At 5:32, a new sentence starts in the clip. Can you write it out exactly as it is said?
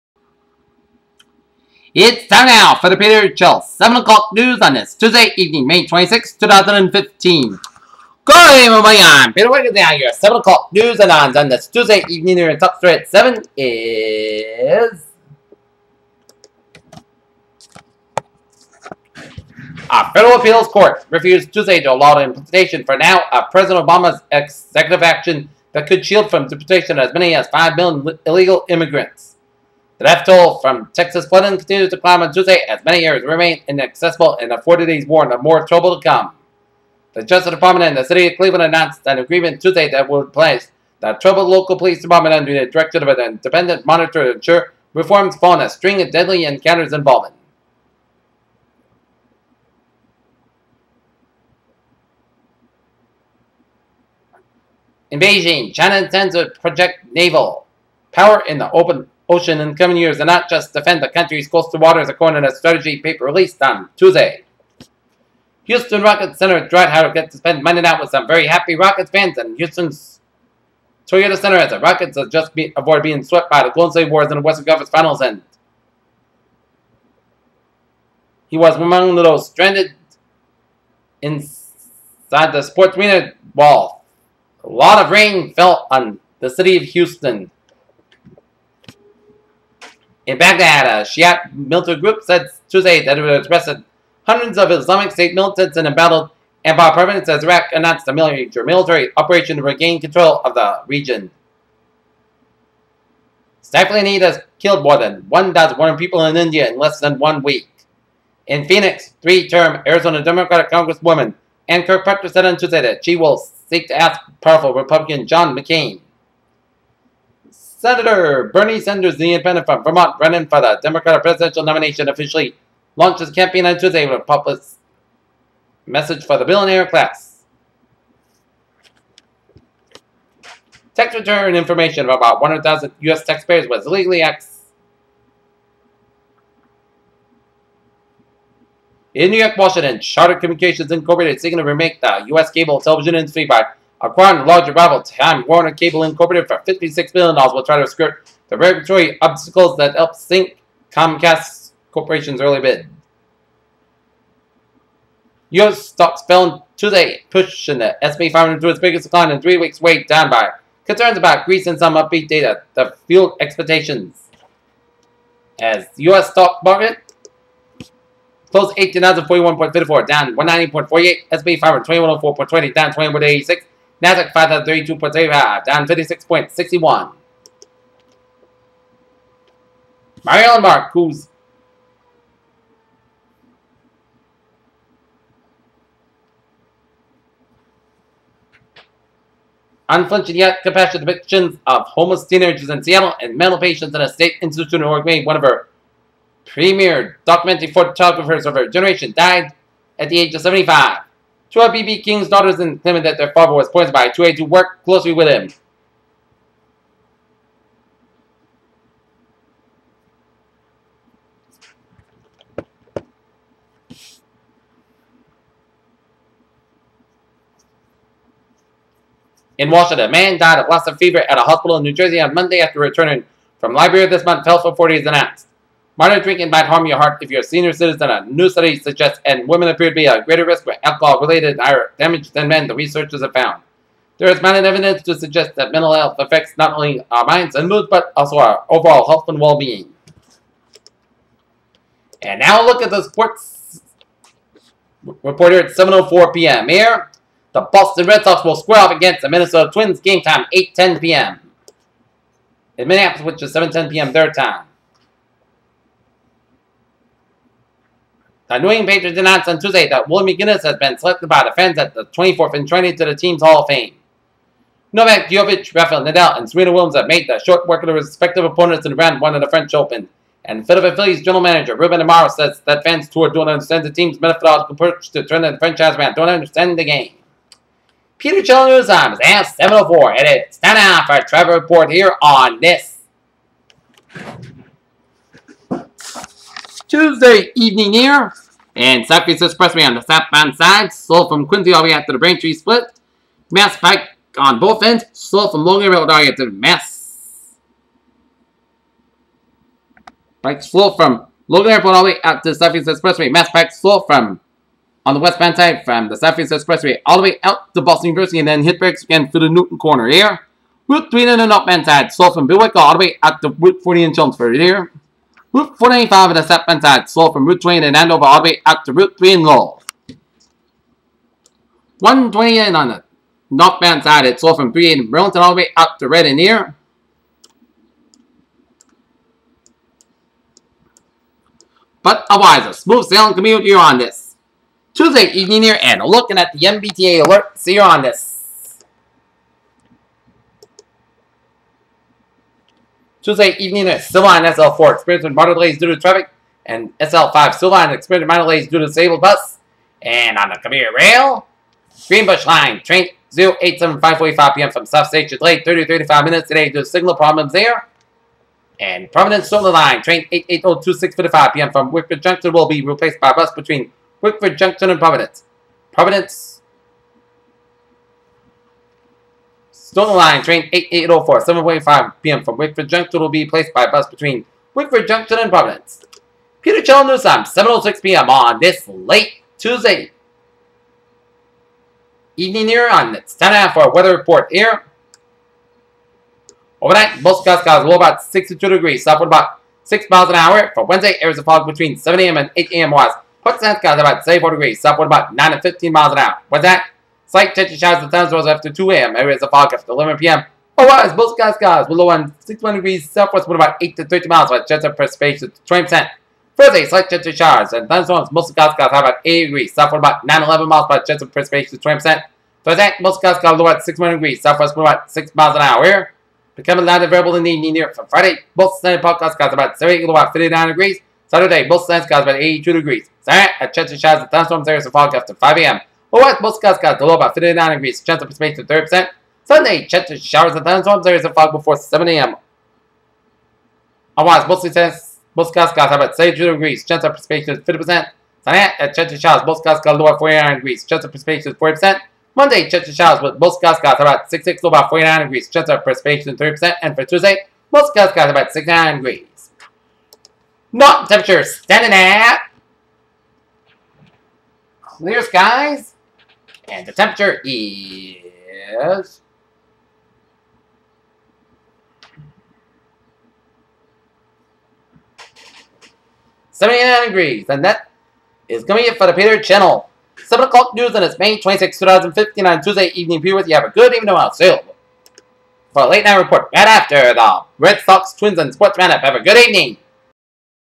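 But otherwise, a smooth sailing commute here on this.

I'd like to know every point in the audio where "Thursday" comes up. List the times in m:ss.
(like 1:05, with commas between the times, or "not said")
6:46, 6:52.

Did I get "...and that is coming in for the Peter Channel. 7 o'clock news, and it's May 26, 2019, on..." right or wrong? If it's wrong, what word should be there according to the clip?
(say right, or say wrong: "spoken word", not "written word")
wrong: "2015", not "2019".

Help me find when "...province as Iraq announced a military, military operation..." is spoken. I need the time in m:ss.
1:36.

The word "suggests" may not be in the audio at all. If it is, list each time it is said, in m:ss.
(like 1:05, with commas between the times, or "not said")
3:48, 3:55.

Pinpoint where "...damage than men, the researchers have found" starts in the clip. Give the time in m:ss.
3:51.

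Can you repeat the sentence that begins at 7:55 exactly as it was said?
For a late night report, right after the Red Sox, Twins, and Sportsman up, Have a good evening.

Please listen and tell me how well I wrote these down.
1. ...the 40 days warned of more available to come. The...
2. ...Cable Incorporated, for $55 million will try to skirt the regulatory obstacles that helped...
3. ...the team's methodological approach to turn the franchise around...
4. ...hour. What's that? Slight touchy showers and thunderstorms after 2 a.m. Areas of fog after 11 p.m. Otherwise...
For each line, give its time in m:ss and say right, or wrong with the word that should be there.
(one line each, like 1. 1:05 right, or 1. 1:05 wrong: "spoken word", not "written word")
1. 0:34 wrong: "trouble", not "available"
2. 2:25 wrong: "56", not "55"
3. 4:33 right
4. 6:36 right.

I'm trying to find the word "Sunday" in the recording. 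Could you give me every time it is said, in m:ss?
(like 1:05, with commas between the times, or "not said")
6:58, 7:09, 7:18.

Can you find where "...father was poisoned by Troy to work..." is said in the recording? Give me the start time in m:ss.
3:23.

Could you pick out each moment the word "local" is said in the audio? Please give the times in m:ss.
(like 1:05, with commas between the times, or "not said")
0:41.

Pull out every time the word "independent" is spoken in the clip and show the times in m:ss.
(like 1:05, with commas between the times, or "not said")
0:43, 1:59.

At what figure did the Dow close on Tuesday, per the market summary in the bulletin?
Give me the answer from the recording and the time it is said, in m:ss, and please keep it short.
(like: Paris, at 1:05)
18,041.54, at 2:48.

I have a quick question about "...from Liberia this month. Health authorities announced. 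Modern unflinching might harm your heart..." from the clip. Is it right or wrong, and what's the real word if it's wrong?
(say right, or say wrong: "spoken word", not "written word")
wrong: "drinking", not "unflinching".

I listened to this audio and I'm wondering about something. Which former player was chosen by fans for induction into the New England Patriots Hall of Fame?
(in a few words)
Will McGinest.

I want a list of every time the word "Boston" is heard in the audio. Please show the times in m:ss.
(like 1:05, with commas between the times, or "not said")
4:07, 5:07.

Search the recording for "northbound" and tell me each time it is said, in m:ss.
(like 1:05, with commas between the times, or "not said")
5:11, 5:23.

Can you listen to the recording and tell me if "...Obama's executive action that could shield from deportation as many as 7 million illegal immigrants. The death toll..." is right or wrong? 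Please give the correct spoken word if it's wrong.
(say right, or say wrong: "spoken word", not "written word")
wrong: "5", not "7".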